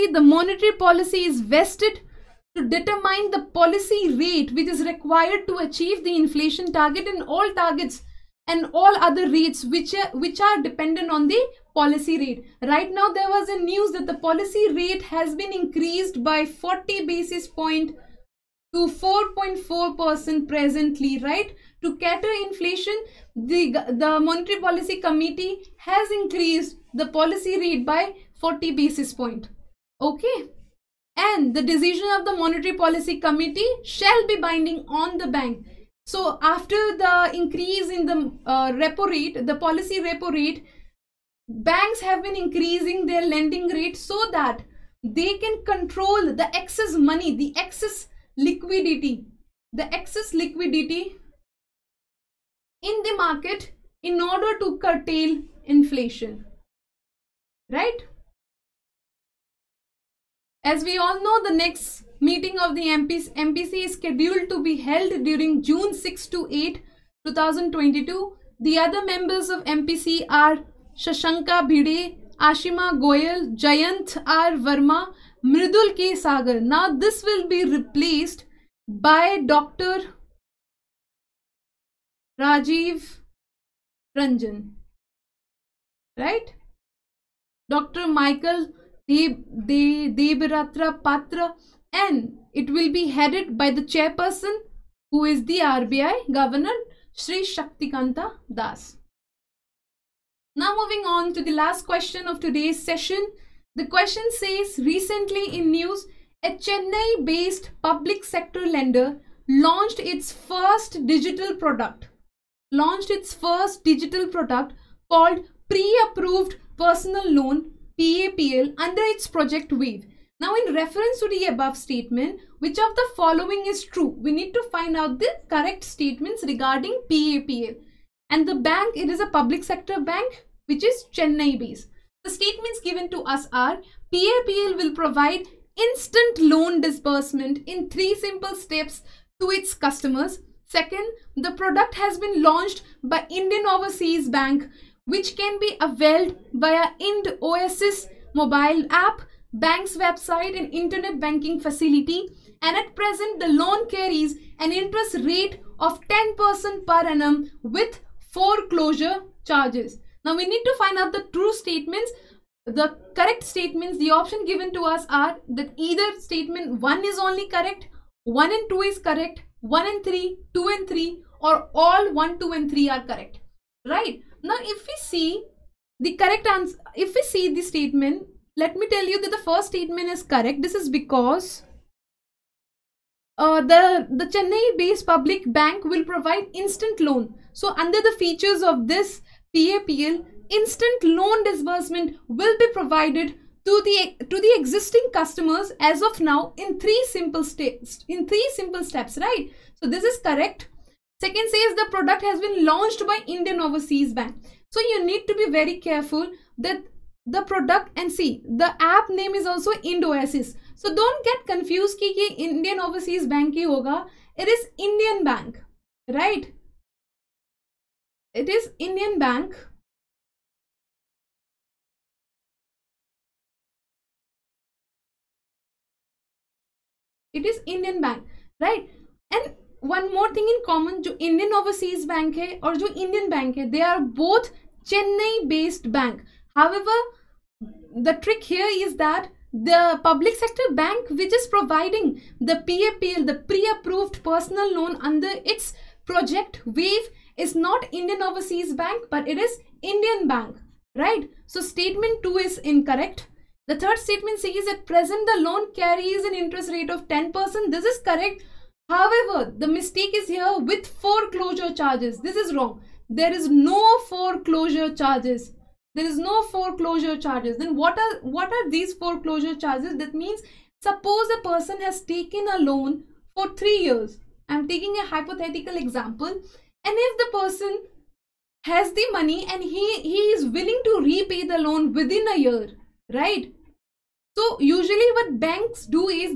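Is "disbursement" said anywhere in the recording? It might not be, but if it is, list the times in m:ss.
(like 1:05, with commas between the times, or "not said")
2:16, 3:11.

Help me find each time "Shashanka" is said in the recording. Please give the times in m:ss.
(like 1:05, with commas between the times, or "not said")
1:10.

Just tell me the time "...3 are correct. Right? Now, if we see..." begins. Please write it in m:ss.
2:52.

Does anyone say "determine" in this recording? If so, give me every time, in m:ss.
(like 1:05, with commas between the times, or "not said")
0:02.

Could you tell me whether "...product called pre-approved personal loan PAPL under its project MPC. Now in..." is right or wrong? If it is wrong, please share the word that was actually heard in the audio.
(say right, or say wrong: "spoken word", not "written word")
wrong: "Wave", not "MPC".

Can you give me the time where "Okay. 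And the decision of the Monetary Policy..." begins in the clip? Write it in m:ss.
0:30.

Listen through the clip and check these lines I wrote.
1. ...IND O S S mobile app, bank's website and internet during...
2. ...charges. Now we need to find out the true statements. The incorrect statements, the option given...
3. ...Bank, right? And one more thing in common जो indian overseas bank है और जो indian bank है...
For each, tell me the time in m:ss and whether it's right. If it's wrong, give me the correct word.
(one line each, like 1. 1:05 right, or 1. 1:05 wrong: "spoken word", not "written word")
1. 2:27 wrong: "banking", not "during"
2. 2:39 wrong: "correct", not "incorrect"
3. 3:48 right.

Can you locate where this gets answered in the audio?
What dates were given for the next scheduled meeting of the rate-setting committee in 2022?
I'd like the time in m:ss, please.
1:05.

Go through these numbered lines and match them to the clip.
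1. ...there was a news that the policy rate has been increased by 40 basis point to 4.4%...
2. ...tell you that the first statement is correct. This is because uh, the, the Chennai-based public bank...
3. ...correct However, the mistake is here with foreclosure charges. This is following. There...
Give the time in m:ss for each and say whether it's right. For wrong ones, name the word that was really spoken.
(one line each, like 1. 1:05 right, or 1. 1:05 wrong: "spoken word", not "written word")
1. 0:13 right
2. 2:58 right
3. 4:18 wrong: "wrong", not "following".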